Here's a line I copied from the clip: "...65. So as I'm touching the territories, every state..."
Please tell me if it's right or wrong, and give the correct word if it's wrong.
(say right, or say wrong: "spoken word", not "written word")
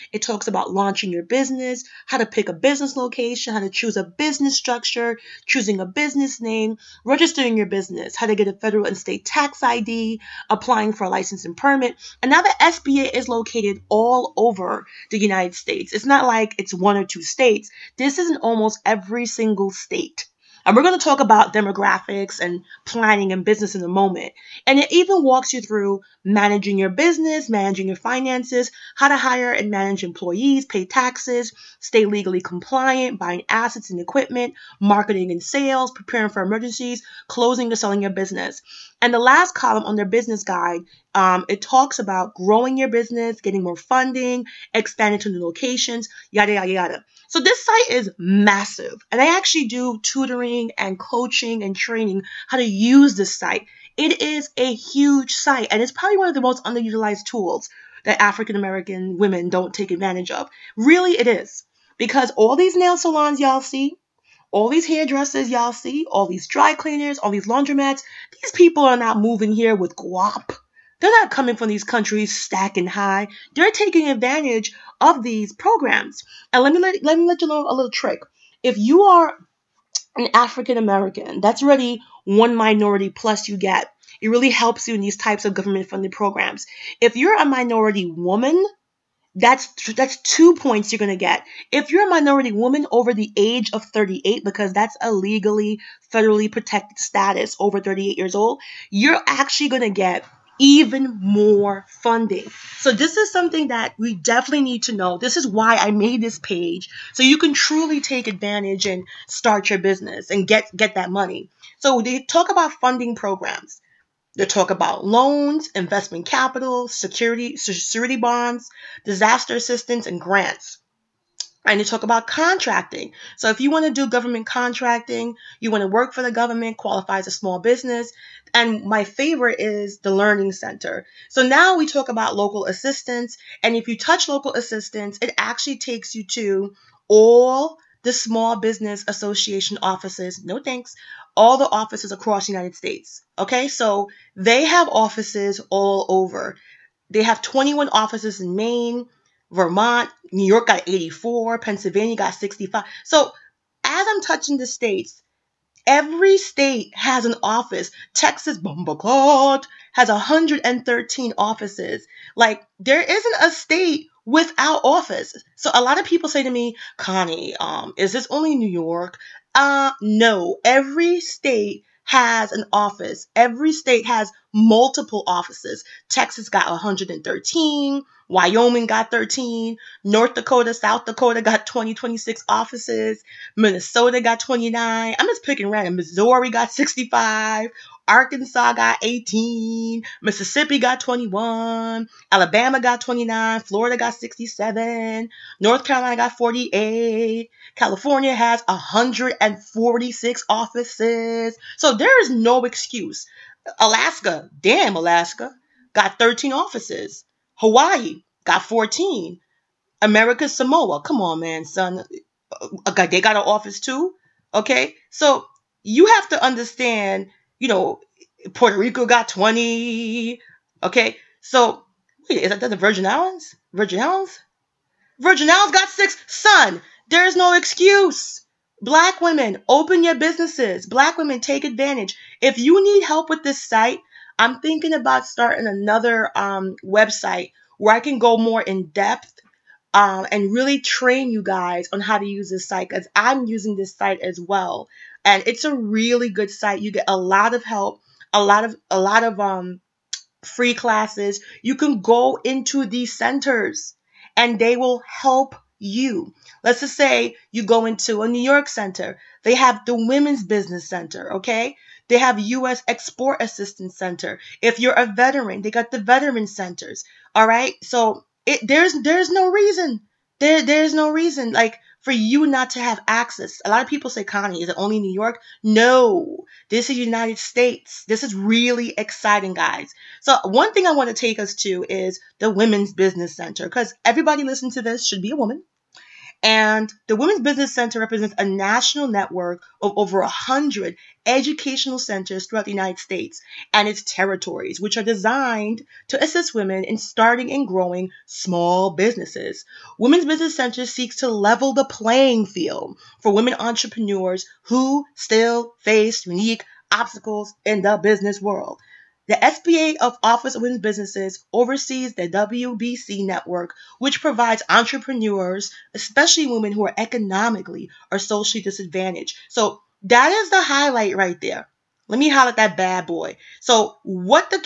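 wrong: "states", not "territories".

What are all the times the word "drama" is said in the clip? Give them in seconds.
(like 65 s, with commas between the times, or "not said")
not said.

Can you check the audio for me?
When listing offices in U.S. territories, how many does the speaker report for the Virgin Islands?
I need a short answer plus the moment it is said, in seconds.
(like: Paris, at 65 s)
6, at 225 s.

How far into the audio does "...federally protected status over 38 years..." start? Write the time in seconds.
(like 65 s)
96 s.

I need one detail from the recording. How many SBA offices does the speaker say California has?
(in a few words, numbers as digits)
146.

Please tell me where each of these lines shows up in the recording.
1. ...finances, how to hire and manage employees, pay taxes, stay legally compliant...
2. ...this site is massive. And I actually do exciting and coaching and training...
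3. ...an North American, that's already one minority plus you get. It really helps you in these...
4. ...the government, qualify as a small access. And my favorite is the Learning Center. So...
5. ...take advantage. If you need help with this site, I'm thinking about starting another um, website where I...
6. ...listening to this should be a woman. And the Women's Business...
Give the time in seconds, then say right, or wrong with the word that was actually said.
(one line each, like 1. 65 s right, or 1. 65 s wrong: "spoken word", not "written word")
1. 27 s right
2. 47 s wrong: "tutoring", not "exciting"
3. 80 s wrong: "African", not "North"
4. 126 s wrong: "business", not "access"
5. 231 s right
6. 284 s right.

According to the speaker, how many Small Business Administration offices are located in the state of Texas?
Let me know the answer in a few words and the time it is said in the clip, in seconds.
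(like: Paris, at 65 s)
113, at 160 s.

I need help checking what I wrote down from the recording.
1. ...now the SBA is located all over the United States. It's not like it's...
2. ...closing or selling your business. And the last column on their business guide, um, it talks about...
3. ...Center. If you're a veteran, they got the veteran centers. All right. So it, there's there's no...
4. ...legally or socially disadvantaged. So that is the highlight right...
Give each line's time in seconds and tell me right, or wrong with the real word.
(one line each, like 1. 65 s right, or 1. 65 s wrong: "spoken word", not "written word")
1. 12 s right
2. 37 s right
3. 263 s right
4. 316 s wrong: "economically", not "legally".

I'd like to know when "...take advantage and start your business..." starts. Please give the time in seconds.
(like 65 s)
107 s.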